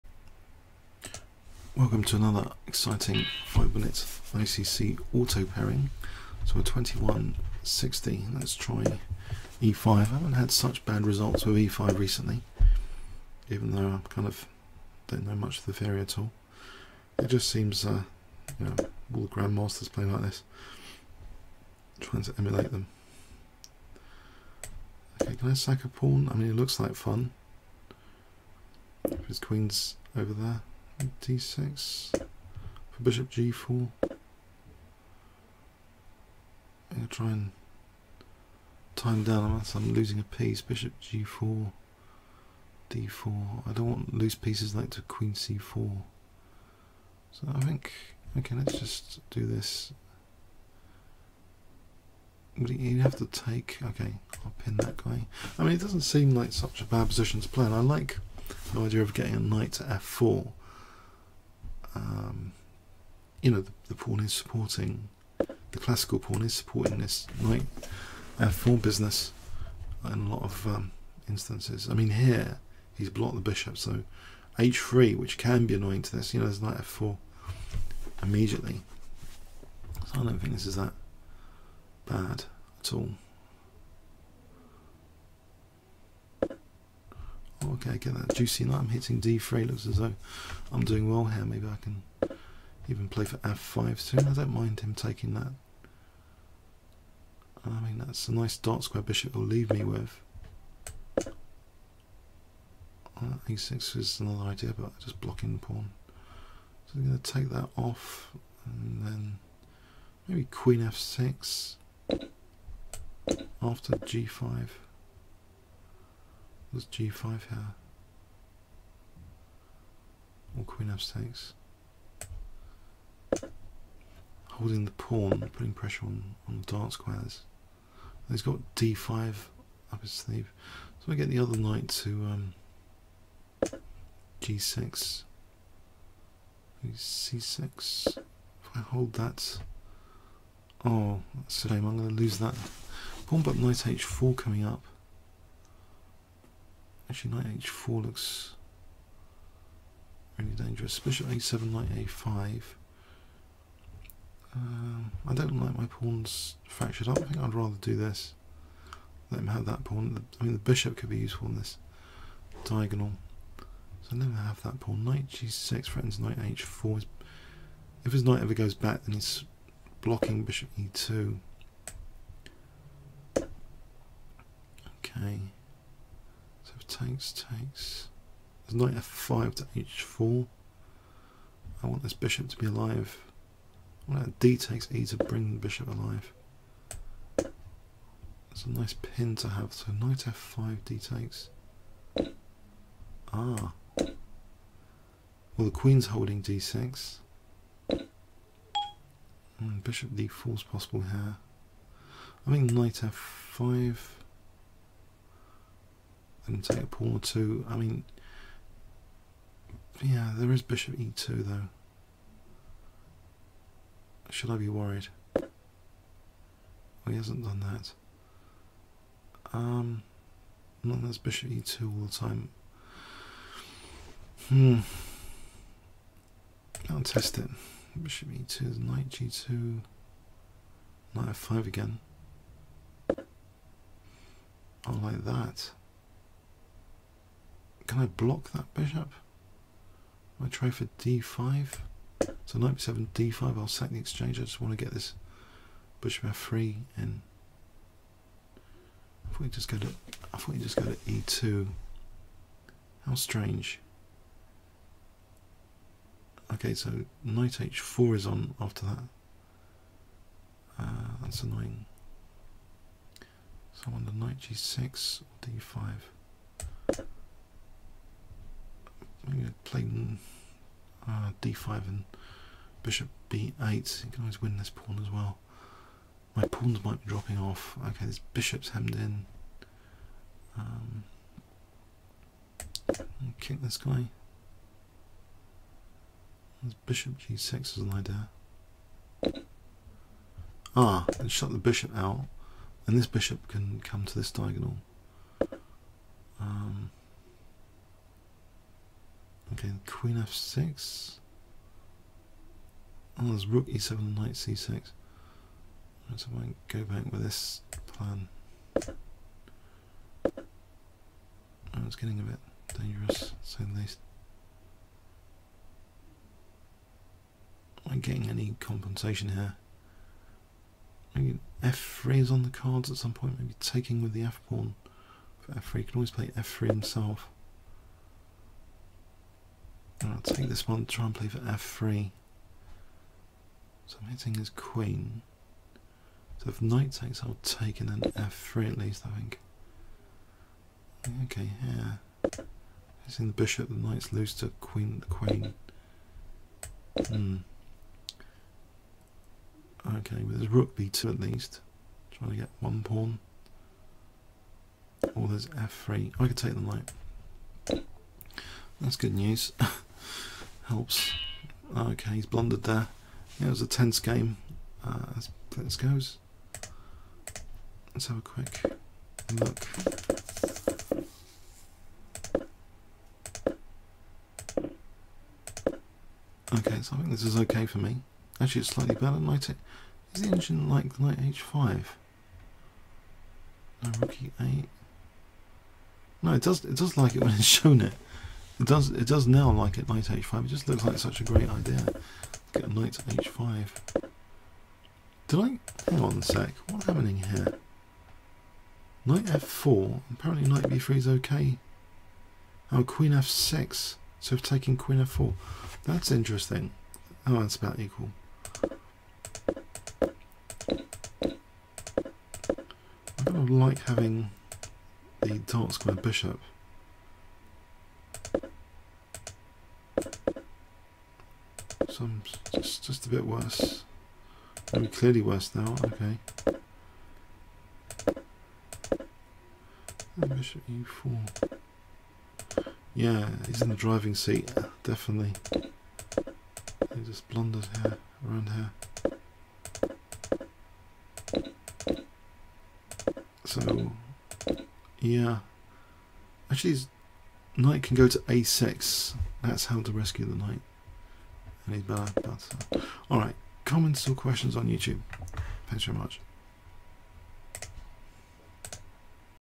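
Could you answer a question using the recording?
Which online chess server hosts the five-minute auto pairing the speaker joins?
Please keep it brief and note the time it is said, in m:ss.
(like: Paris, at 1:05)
ICC, at 0:04.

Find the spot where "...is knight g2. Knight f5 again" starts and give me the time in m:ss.
3:48.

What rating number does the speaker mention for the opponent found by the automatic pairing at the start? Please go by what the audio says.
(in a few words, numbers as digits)
2160.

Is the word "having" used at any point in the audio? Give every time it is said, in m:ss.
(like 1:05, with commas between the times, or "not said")
6:53.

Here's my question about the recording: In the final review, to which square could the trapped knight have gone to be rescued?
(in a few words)
a6.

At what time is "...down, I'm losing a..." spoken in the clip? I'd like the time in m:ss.
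0:39.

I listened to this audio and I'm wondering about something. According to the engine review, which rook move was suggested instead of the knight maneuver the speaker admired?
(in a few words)
Rook e8.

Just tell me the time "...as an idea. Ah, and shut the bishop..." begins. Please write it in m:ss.
4:47.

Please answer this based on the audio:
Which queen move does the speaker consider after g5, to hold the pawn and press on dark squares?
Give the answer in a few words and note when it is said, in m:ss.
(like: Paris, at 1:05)
Queen f6, at 1:50.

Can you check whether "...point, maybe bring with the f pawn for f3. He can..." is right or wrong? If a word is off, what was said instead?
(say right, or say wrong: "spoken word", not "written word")
wrong: "taking", not "bring".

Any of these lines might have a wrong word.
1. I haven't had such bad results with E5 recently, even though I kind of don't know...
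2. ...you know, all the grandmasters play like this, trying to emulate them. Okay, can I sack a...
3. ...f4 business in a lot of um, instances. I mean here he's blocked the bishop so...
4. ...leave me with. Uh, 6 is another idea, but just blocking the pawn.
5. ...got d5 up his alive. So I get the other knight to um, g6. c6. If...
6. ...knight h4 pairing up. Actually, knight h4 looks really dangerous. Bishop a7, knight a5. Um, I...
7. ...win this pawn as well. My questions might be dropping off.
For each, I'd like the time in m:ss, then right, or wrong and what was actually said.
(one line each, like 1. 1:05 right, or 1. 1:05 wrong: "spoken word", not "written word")
1. 0:09 right
2. 0:18 right
3. 1:08 right
4. 1:39 right
5. 2:08 wrong: "sleeve", not "alive"
6. 2:23 wrong: "coming", not "pairing"
7. 4:34 wrong: "pawns", not "questions".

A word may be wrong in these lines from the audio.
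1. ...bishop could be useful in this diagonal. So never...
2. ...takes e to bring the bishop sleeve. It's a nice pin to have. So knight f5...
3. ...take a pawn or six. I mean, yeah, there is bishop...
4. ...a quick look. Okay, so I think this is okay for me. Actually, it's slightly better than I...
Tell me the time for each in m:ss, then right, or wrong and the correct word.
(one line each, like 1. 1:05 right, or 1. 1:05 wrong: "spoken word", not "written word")
1. 2:40 right
2. 3:04 wrong: "alive", not "sleeve"
3. 3:26 wrong: "two", not "six"
4. 6:08 right.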